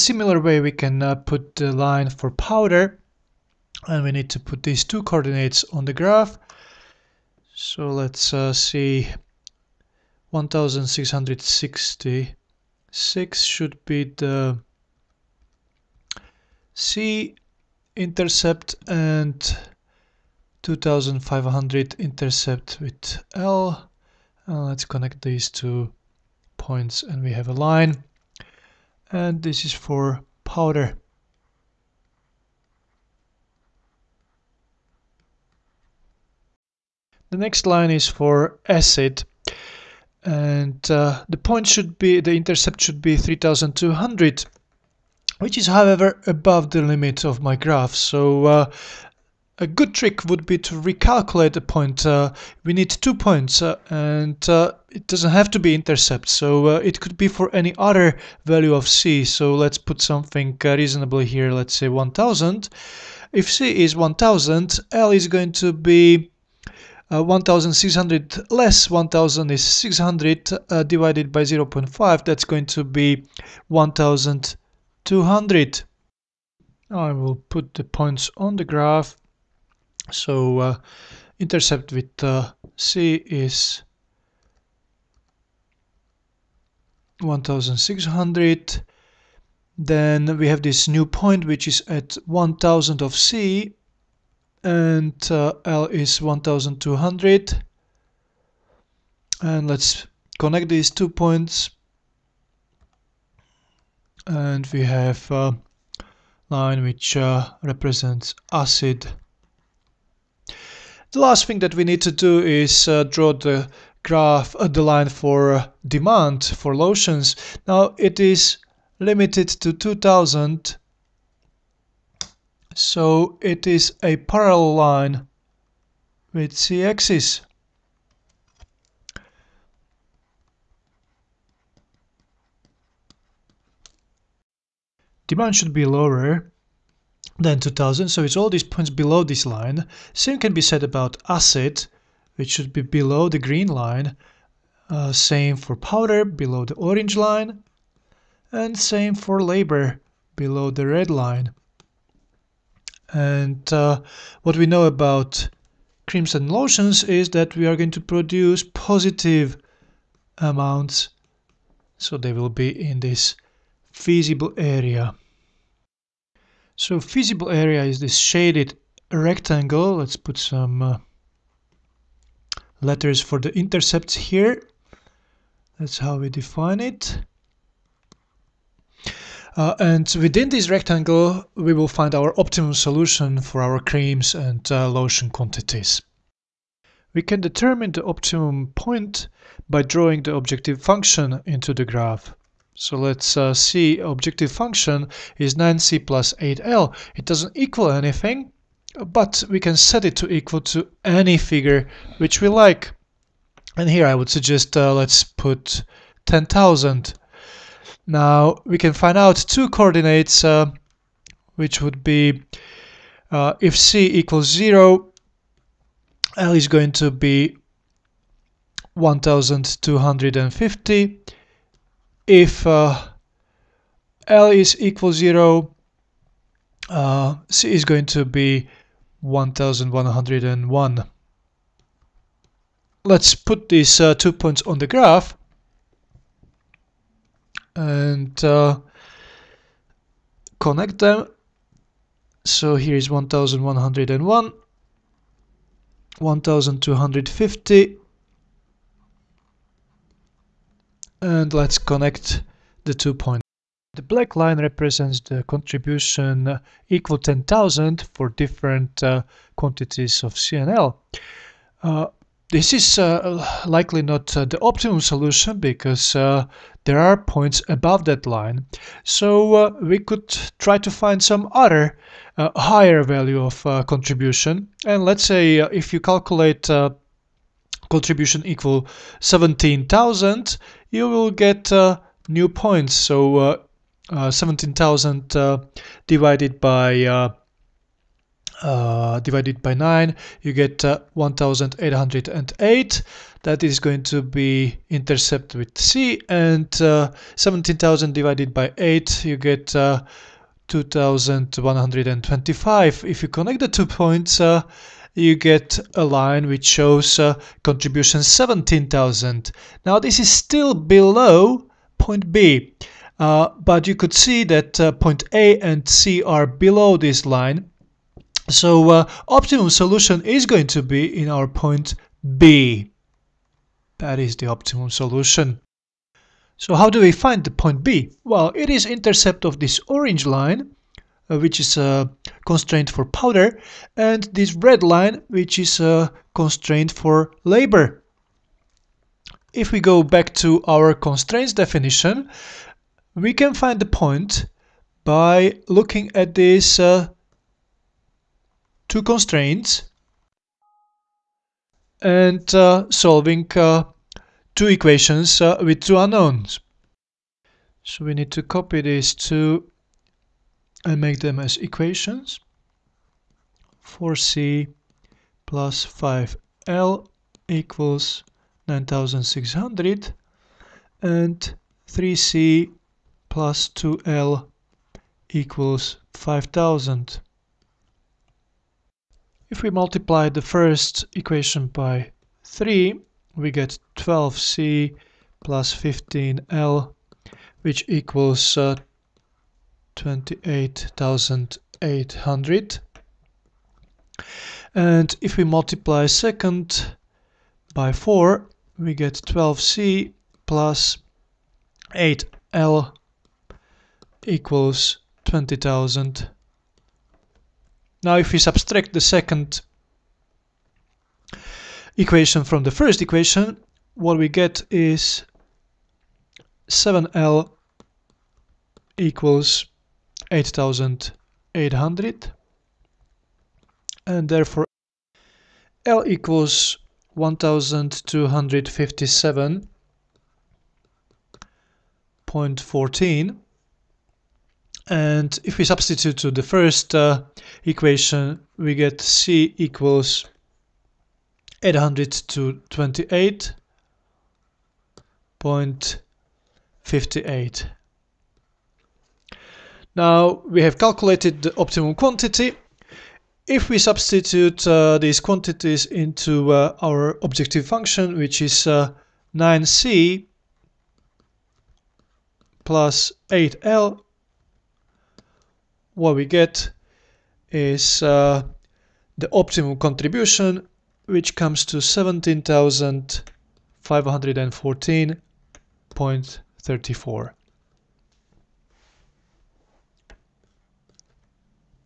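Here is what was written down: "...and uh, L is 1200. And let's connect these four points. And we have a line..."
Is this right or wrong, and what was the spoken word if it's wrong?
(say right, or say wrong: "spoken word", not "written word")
wrong: "two", not "four".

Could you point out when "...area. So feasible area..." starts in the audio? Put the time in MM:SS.
02:44.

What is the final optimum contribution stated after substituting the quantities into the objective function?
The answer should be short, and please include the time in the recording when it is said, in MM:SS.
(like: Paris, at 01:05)
17,514.34, at 07:51.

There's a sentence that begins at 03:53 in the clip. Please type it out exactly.
Let's put these uh, two points on the graph and uh, connect them.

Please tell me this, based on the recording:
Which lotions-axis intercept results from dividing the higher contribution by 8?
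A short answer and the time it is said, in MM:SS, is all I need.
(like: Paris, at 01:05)
2125, at 04:59.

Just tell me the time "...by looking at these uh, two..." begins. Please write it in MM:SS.
05:45.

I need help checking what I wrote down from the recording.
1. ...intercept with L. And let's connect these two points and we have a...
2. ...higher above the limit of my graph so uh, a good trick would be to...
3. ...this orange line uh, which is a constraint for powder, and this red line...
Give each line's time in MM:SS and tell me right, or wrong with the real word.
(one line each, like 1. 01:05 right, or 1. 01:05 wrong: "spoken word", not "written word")
1. 00:21 right
2. 00:45 wrong: "however", not "higher"
3. 05:29 right.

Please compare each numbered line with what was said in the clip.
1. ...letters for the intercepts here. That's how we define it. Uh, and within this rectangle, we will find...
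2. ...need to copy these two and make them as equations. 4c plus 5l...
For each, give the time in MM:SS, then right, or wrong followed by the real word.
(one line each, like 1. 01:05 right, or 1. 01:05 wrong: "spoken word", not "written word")
1. 02:52 right
2. 05:58 right.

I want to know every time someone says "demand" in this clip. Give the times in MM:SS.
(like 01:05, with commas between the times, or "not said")
01:55, 02:15.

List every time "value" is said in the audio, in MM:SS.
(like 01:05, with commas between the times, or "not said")
00:58, 04:33.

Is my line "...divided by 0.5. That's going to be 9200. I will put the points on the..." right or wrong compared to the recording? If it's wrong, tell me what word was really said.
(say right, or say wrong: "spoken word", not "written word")
wrong: "1200", not "9200".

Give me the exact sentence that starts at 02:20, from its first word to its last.
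Same can be said about acid, which should be below the green line.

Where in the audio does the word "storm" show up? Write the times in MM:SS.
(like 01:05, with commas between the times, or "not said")
not said.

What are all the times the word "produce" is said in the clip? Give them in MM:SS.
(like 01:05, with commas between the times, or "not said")
02:38.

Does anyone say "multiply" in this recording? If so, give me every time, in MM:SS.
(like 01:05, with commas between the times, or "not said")
06:19, 06:35.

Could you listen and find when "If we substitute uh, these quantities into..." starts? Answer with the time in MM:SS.
07:33.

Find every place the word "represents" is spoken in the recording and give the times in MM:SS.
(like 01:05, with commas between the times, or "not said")
01:47, 04:14.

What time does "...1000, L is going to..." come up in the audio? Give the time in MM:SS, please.
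01:03.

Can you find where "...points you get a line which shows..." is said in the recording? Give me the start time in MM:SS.
05:03.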